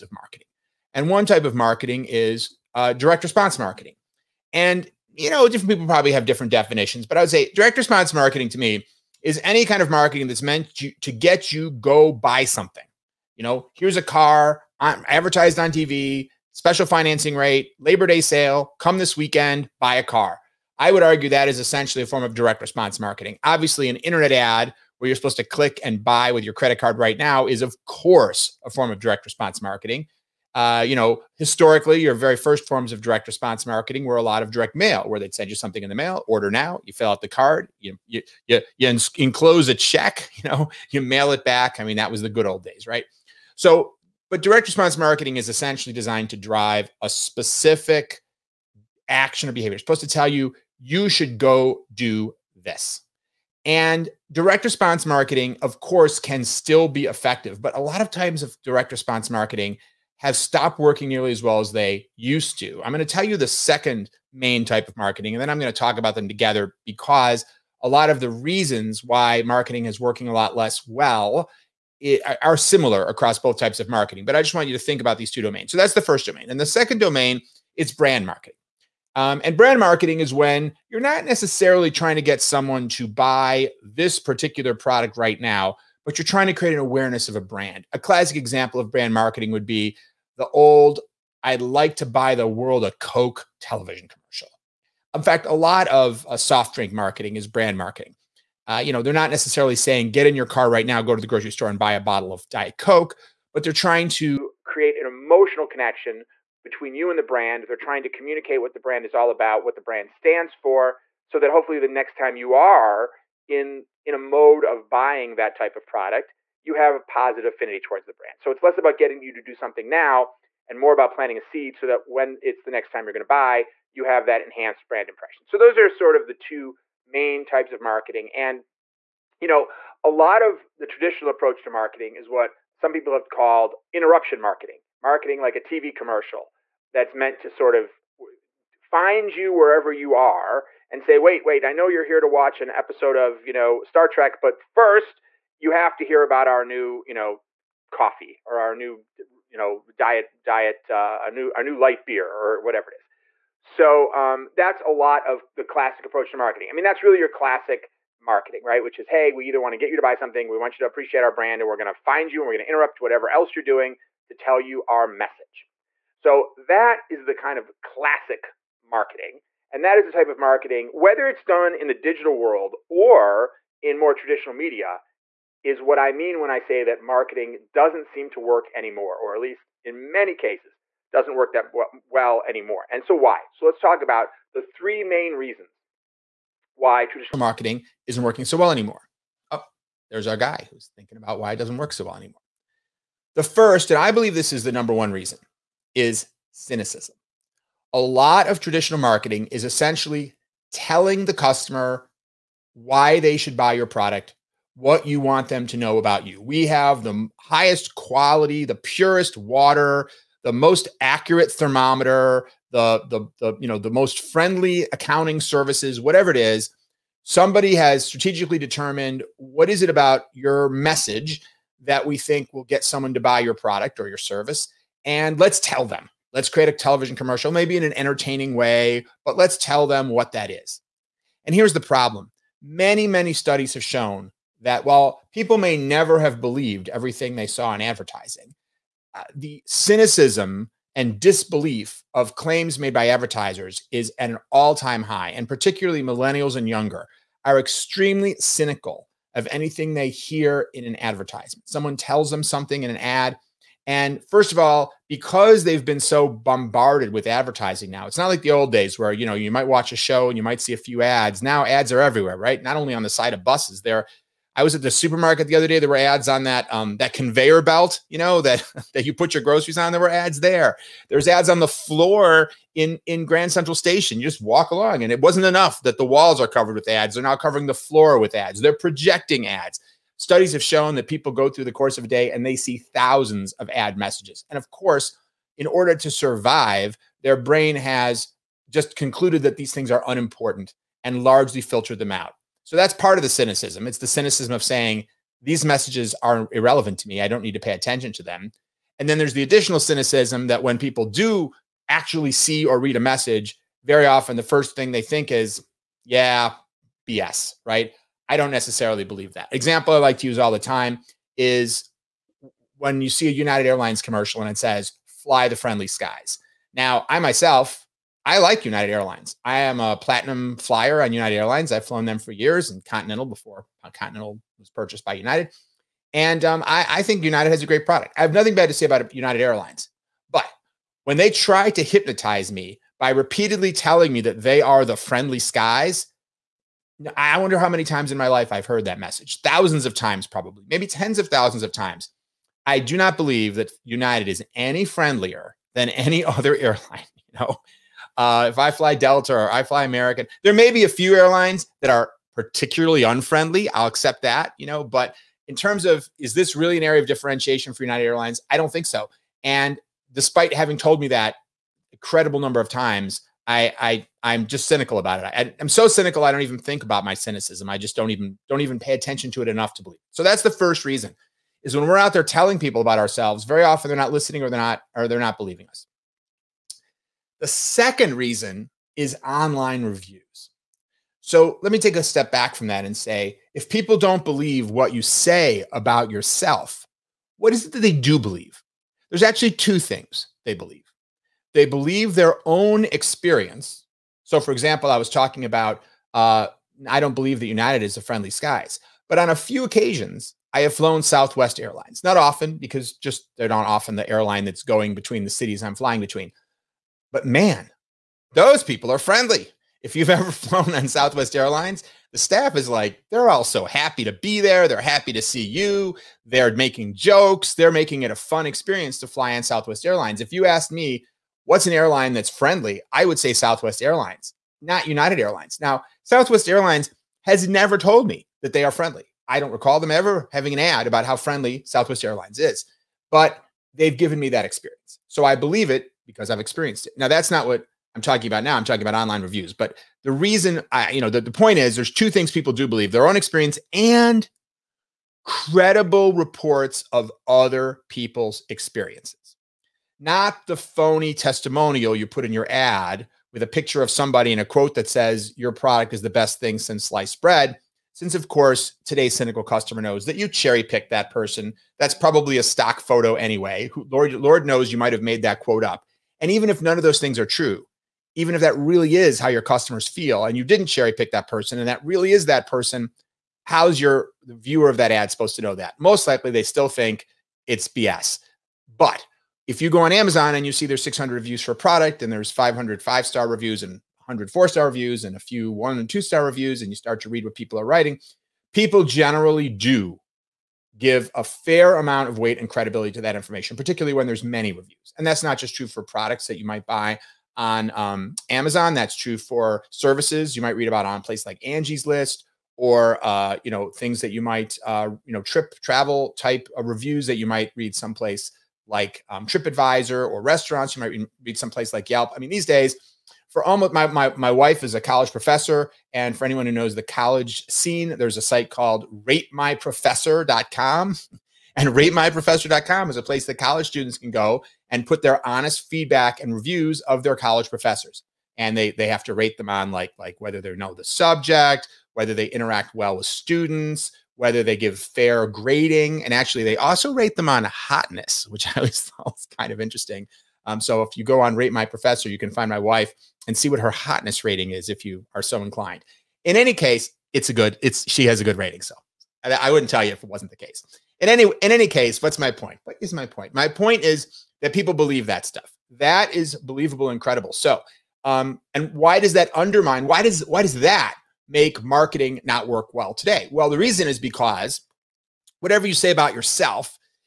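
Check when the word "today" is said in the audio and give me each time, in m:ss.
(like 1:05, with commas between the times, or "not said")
7:38, 9:22.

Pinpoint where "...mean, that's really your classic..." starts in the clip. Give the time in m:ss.
2:36.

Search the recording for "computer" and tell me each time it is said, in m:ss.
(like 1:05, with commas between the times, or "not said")
not said.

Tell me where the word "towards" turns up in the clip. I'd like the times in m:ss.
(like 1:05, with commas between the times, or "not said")
1:57.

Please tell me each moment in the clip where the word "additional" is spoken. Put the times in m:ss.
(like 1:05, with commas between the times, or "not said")
4:59.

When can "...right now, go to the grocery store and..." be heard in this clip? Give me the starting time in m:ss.
1:40.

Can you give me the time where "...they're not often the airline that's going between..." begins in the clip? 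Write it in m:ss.
6:43.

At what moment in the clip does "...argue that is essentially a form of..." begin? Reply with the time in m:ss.
0:21.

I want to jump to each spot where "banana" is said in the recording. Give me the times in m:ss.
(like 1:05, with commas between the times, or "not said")
not said.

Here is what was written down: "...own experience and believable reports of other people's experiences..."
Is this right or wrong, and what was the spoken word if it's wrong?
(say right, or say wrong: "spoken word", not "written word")
wrong: "credible", not "believable".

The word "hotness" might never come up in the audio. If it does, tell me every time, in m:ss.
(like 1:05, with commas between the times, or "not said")
8:57, 9:03.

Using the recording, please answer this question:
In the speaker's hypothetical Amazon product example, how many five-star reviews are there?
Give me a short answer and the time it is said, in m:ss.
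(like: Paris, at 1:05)
500, at 8:02.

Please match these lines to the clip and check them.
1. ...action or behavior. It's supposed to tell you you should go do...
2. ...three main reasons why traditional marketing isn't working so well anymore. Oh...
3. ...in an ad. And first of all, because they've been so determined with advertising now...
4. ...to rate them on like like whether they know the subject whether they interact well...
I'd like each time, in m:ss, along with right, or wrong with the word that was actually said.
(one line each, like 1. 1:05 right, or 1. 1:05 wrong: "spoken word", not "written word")
1. 0:49 right
2. 3:04 right
3. 4:12 wrong: "bombarded", not "determined"
4. 8:49 right.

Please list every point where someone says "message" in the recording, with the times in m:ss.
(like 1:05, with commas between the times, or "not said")
2:45, 3:40, 4:43, 4:55, 5:03, 5:38.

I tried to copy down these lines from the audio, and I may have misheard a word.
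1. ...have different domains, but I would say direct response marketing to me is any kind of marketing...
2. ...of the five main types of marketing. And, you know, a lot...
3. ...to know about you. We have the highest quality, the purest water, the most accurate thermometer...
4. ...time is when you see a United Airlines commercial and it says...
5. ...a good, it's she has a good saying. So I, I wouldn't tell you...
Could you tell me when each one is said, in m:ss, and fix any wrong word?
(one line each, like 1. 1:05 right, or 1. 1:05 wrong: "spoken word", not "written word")
1. 0:06 wrong: "definitions", not "domains"
2. 2:06 wrong: "two", not "five"
3. 3:25 right
4. 5:10 right
5. 9:07 wrong: "rating", not "saying".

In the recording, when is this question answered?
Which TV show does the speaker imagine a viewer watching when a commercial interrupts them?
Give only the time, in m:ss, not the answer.
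2:23.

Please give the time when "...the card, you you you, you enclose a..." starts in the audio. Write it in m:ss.
0:37.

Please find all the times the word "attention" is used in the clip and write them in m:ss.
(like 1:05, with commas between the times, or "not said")
4:57, 6:08.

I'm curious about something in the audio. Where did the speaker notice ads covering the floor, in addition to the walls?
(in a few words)
Grand Central Station.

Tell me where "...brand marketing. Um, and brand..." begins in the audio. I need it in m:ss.
1:17.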